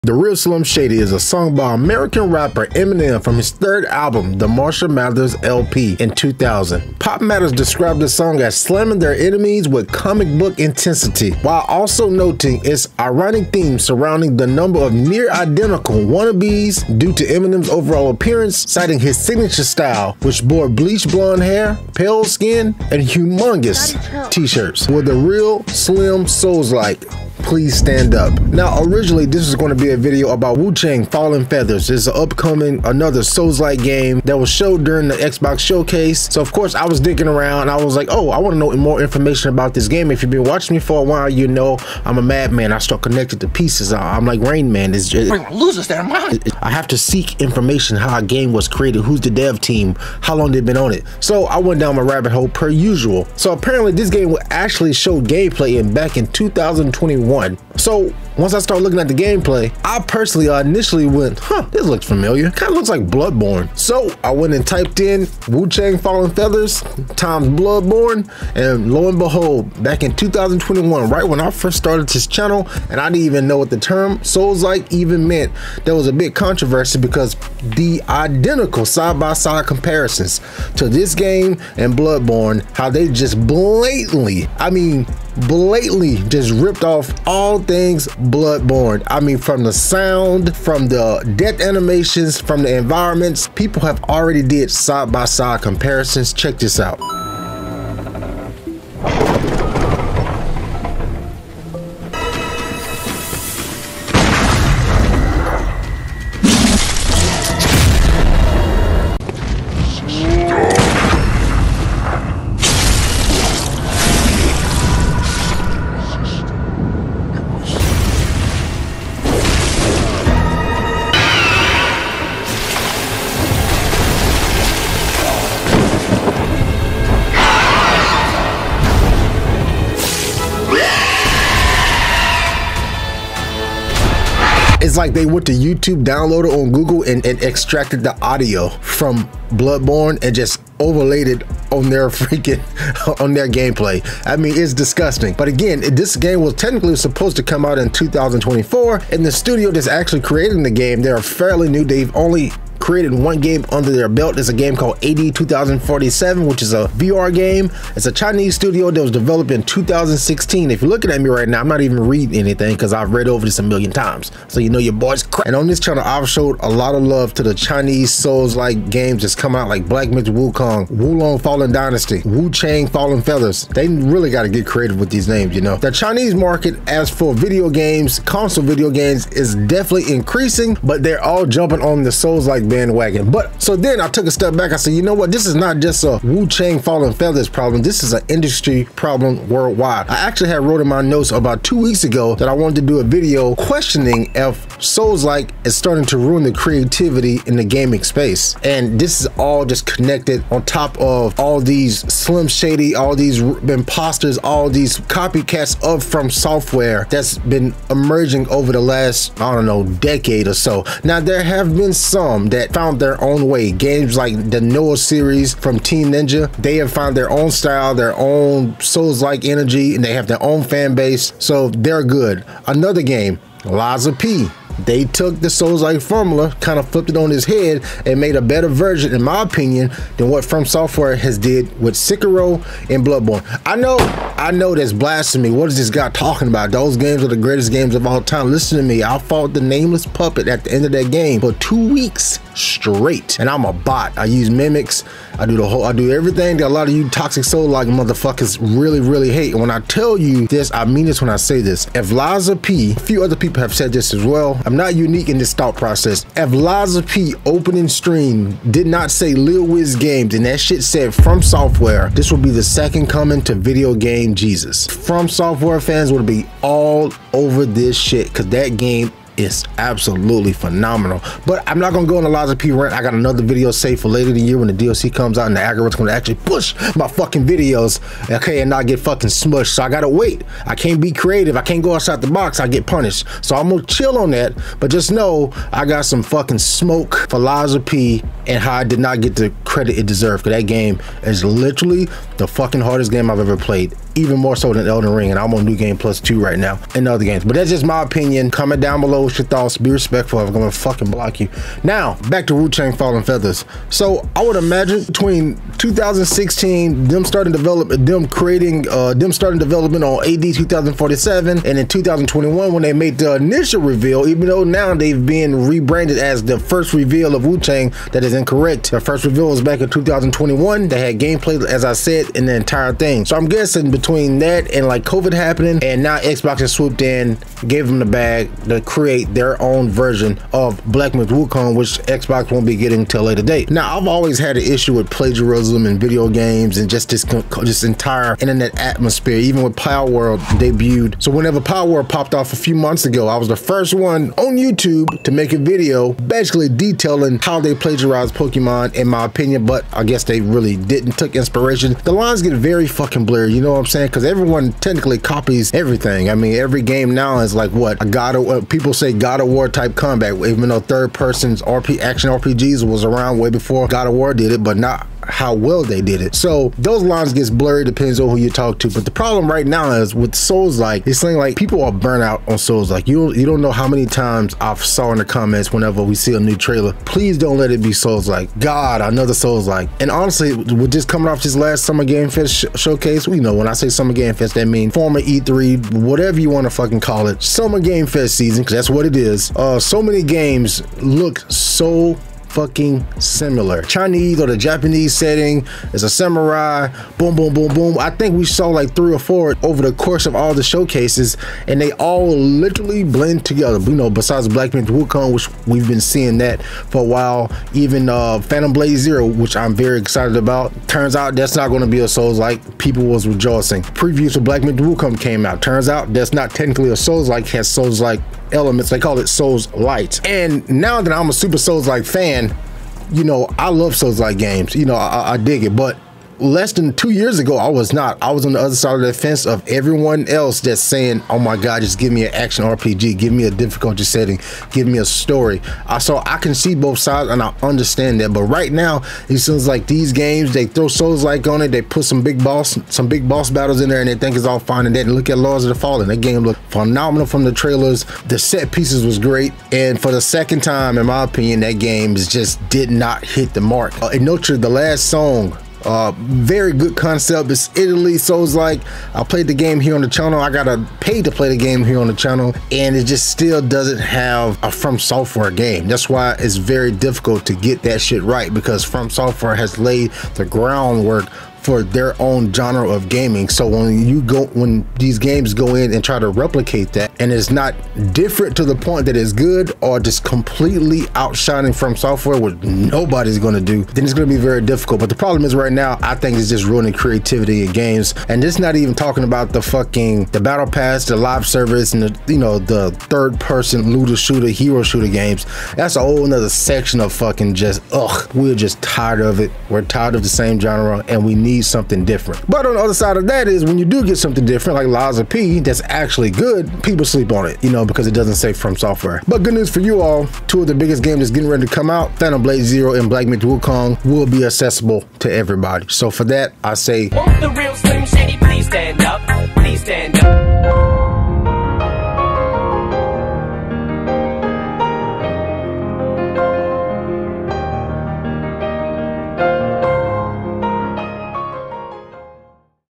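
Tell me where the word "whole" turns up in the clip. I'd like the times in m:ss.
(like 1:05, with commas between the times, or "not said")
4:05, 8:16.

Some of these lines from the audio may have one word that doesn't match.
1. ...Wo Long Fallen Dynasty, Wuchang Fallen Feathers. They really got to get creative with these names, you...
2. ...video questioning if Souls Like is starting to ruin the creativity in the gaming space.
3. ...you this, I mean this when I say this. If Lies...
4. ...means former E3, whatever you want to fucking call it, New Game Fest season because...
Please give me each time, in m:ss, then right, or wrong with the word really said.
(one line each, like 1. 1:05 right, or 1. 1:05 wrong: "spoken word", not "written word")
1. 2:50 right
2. 3:13 right
3. 4:10 right
4. 6:24 wrong: "Summer", not "New".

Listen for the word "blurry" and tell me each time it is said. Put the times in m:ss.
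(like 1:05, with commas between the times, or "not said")
5:53, 6:07.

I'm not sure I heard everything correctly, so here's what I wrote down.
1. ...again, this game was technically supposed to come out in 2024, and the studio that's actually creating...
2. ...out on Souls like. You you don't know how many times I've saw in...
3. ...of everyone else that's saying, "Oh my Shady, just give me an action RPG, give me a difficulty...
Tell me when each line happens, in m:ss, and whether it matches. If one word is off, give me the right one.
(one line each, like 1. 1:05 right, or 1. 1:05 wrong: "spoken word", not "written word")
1. 2:25 right
2. 6:12 right
3. 7:09 wrong: "God", not "Shady".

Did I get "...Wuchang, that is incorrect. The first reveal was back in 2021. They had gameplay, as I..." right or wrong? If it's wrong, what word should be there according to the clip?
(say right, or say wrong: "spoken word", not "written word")
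right.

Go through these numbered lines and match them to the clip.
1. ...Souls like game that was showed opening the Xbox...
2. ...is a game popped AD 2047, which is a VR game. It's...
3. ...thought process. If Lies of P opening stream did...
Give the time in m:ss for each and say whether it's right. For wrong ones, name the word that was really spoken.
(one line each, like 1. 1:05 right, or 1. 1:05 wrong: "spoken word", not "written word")
1. 0:33 wrong: "during", not "opening"
2. 2:34 wrong: "called", not "popped"
3. 4:15 right.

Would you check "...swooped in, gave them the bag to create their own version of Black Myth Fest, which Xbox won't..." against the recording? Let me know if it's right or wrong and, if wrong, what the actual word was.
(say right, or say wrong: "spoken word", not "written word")
wrong: "Wukong", not "Fest".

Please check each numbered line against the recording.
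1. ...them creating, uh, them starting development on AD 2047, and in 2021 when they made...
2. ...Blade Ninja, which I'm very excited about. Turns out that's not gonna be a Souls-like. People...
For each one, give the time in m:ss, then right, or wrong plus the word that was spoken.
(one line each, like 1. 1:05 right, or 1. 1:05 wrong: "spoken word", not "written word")
1. 5:08 right
2. 6:48 wrong: "Zero", not "Ninja".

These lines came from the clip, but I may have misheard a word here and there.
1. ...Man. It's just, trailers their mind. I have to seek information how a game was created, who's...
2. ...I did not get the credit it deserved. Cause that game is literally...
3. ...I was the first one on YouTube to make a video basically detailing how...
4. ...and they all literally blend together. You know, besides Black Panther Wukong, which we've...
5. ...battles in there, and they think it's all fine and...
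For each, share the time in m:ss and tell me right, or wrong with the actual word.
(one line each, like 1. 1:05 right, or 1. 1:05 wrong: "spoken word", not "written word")
1. 0:44 wrong: "losers", not "trailers"
2. 4:48 right
3. 5:43 right
4. 6:41 right
5. 7:23 right.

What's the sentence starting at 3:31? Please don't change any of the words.
Now, there have been some that that found their own way.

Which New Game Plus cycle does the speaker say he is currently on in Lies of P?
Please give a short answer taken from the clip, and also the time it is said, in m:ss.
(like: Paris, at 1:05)
New Game Plus 2, at 4:55.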